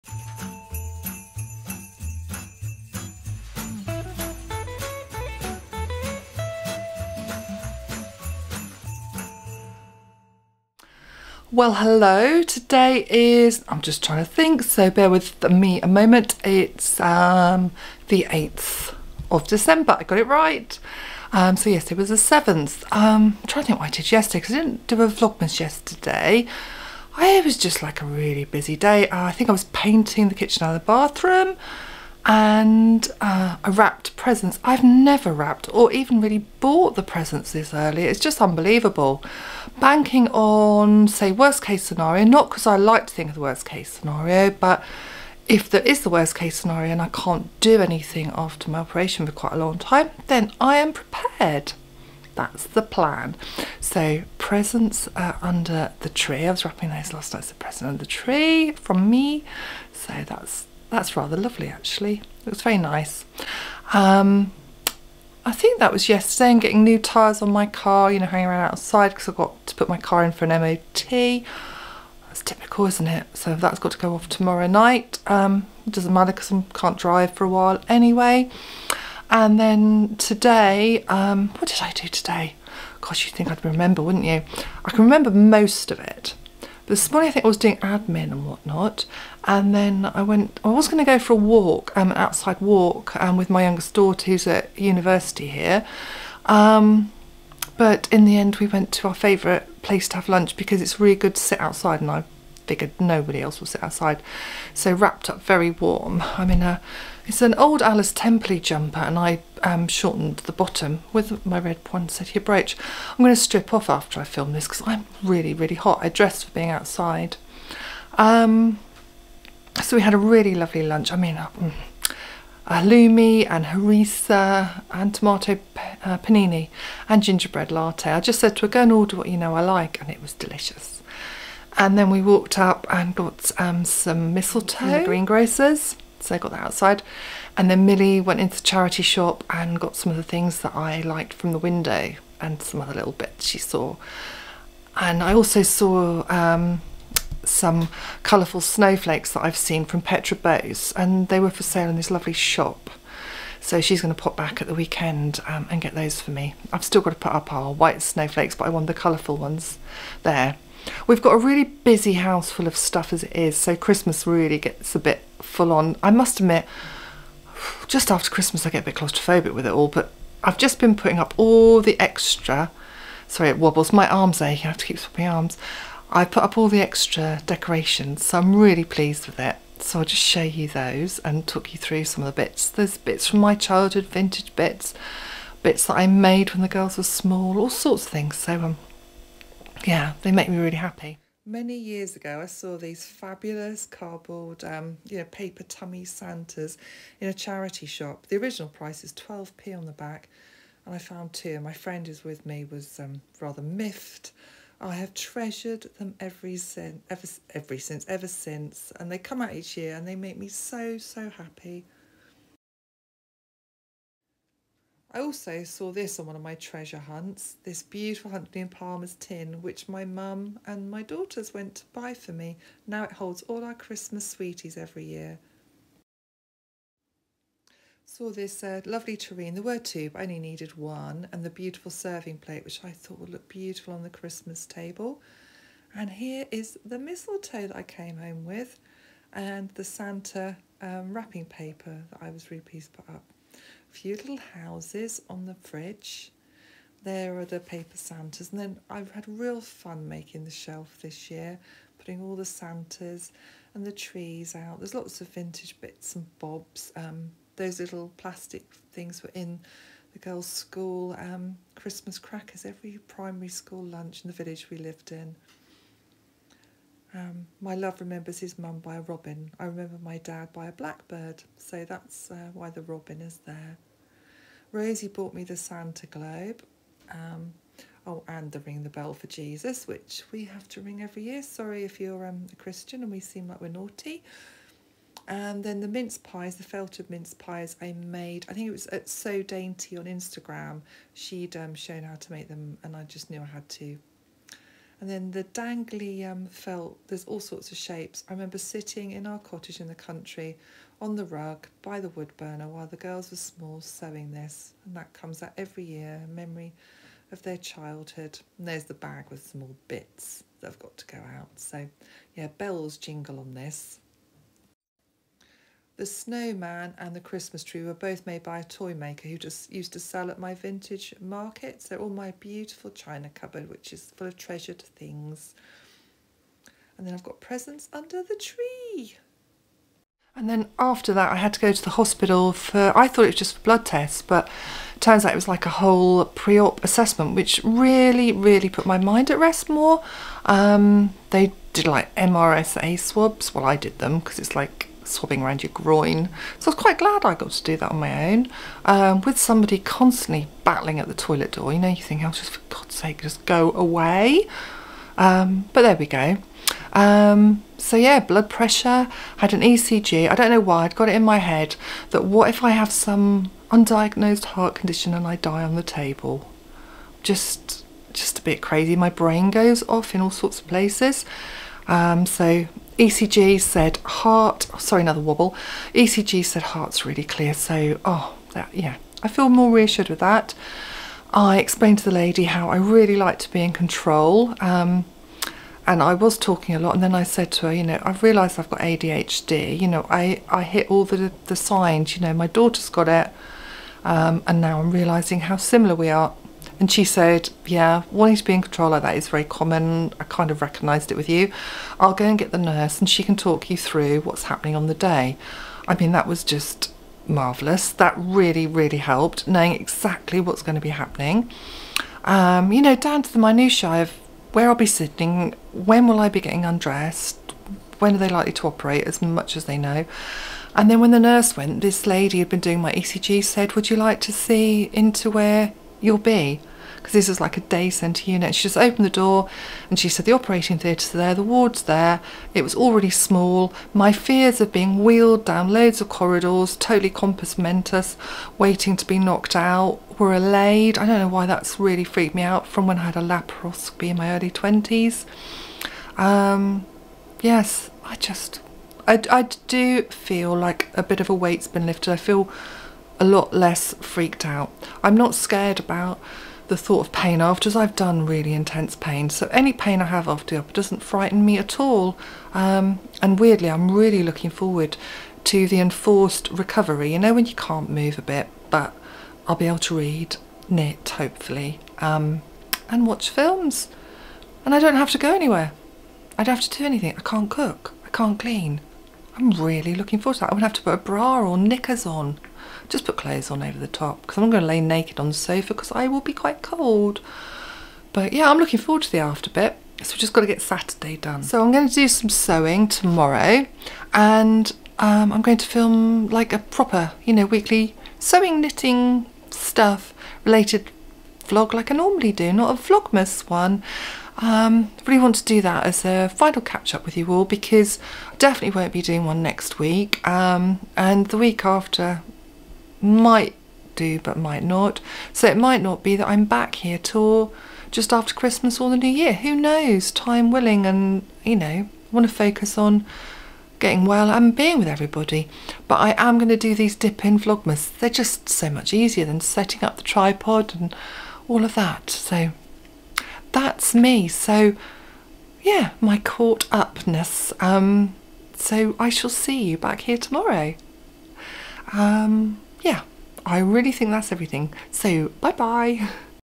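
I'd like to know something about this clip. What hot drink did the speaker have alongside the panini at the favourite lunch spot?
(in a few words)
Gingerbread latte.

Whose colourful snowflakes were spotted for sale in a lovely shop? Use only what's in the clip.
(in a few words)
Petra Boase.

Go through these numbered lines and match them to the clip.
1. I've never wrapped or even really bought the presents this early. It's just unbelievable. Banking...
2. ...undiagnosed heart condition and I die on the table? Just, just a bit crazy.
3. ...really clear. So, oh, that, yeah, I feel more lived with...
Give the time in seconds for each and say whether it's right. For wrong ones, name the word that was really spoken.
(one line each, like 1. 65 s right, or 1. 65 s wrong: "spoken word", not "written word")
1. 34 s right
2. 363 s right
3. 377 s wrong: "reassured", not "lived".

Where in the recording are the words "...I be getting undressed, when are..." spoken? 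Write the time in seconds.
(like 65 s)
416 s.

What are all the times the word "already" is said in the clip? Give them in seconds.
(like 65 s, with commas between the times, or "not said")
432 s.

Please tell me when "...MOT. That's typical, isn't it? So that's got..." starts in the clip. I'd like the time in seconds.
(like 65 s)
70 s.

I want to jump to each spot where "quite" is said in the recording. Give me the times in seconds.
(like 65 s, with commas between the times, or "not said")
49 s, 346 s, 486 s.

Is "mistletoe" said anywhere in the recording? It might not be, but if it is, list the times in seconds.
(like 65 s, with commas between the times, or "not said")
134 s, 236 s.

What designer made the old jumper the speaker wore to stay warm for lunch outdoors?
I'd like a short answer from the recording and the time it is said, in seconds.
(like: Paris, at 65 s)
Alice Temperley, at 107 s.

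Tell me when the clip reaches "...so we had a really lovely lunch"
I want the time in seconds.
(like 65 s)
119 s.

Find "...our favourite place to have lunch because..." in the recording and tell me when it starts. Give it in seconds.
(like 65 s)
99 s.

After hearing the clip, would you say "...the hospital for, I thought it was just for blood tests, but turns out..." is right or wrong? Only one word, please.
right.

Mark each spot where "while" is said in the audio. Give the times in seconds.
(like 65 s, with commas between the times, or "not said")
77 s, 302 s.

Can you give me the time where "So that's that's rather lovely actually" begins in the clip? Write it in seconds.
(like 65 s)
59 s.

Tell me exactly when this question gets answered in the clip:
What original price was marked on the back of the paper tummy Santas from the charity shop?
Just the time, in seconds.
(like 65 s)
199 s.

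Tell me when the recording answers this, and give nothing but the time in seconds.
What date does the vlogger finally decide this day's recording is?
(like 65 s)
18 s.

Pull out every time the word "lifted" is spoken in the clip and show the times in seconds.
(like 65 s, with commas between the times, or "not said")
451 s.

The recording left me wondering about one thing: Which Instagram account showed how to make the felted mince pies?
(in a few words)
So Dainty.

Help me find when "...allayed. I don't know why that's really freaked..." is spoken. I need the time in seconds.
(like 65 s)
440 s.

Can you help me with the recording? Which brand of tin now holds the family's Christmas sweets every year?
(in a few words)
Huntley and Palmer's.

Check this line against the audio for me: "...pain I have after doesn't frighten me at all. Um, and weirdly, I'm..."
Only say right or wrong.
right.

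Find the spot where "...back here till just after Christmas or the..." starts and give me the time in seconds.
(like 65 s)
516 s.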